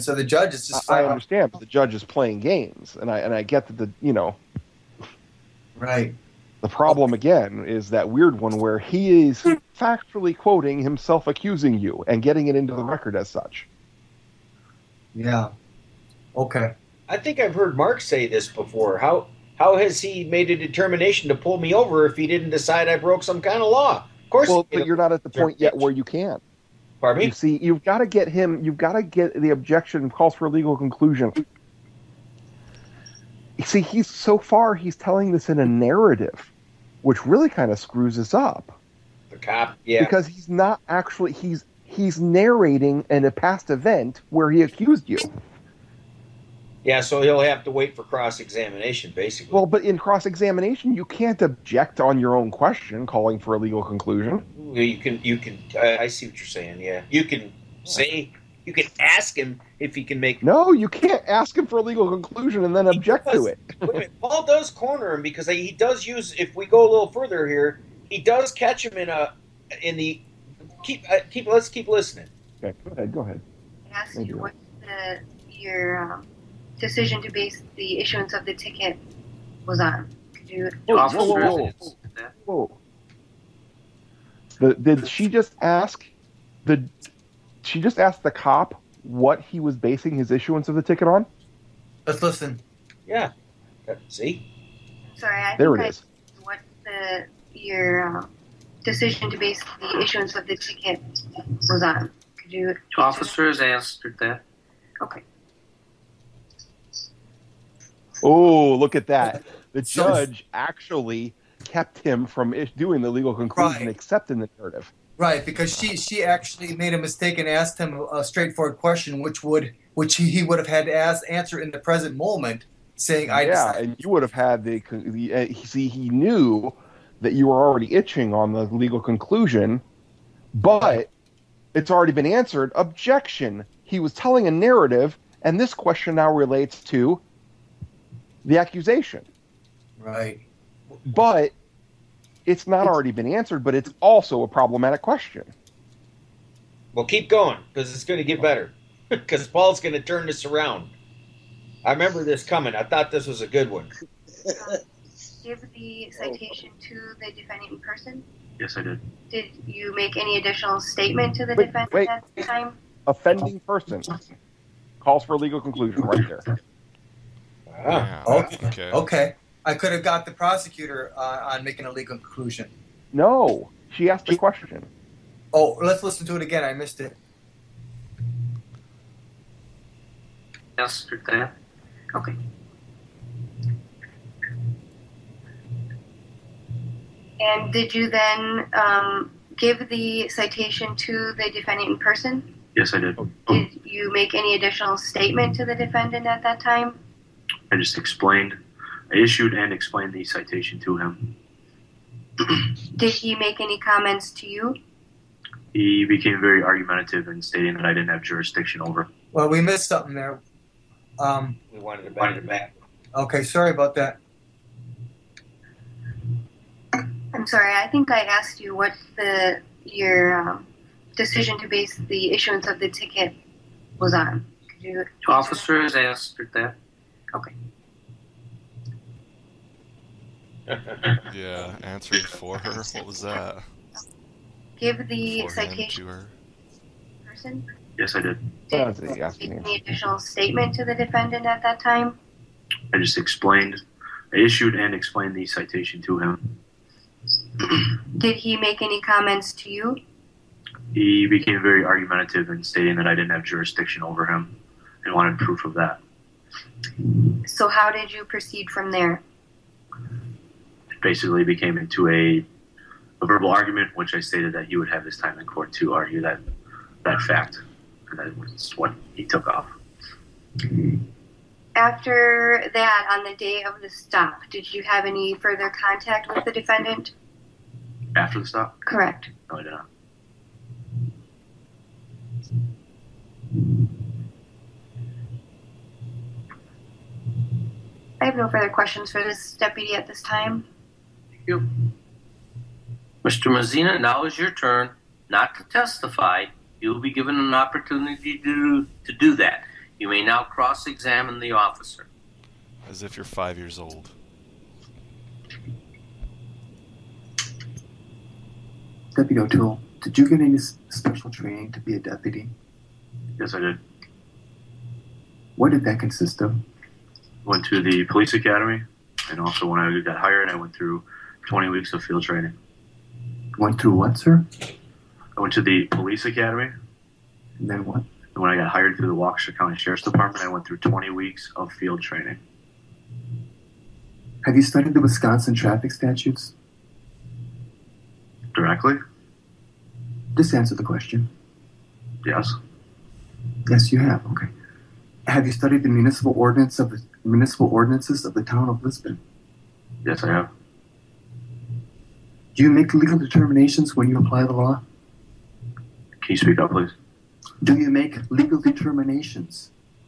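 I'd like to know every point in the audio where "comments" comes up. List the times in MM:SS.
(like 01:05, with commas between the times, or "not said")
03:23, 04:08.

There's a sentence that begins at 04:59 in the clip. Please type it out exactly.
You may now cross examine the officer.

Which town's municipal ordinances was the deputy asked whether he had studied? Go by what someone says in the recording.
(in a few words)
Lisbon.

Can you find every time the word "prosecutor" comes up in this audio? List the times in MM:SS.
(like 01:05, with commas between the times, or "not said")
02:50.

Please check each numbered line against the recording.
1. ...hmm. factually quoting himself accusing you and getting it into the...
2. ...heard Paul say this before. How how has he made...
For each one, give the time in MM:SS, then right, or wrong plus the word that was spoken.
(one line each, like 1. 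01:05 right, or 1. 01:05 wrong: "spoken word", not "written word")
1. 00:09 right
2. 00:17 wrong: "Mark", not "Paul".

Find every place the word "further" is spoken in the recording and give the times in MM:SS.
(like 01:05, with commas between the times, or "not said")
01:07, 04:35, 04:48.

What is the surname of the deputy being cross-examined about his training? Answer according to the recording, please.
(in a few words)
O'Toole.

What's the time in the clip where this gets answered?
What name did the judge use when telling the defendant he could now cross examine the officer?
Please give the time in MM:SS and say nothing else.
04:53.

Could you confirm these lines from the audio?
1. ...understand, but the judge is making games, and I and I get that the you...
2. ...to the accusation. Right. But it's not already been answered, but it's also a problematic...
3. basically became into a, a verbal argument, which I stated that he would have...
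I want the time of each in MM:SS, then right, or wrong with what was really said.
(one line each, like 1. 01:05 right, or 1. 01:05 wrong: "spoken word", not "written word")
1. 00:01 wrong: "playing", not "making"
2. 02:16 right
3. 04:21 right.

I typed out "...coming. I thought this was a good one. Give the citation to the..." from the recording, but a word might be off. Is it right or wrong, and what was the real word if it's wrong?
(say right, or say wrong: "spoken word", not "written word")
right.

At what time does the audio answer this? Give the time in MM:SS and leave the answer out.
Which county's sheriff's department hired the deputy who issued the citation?
05:29.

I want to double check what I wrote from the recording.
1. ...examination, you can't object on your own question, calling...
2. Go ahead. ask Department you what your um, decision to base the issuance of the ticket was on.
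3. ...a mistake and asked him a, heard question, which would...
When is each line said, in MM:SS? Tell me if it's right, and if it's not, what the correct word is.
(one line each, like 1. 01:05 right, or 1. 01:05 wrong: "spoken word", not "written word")
1. 00:50 right
2. 01:13 wrong: "Thank", not "Department"
3. 01:56 wrong: "straightforward", not "heard".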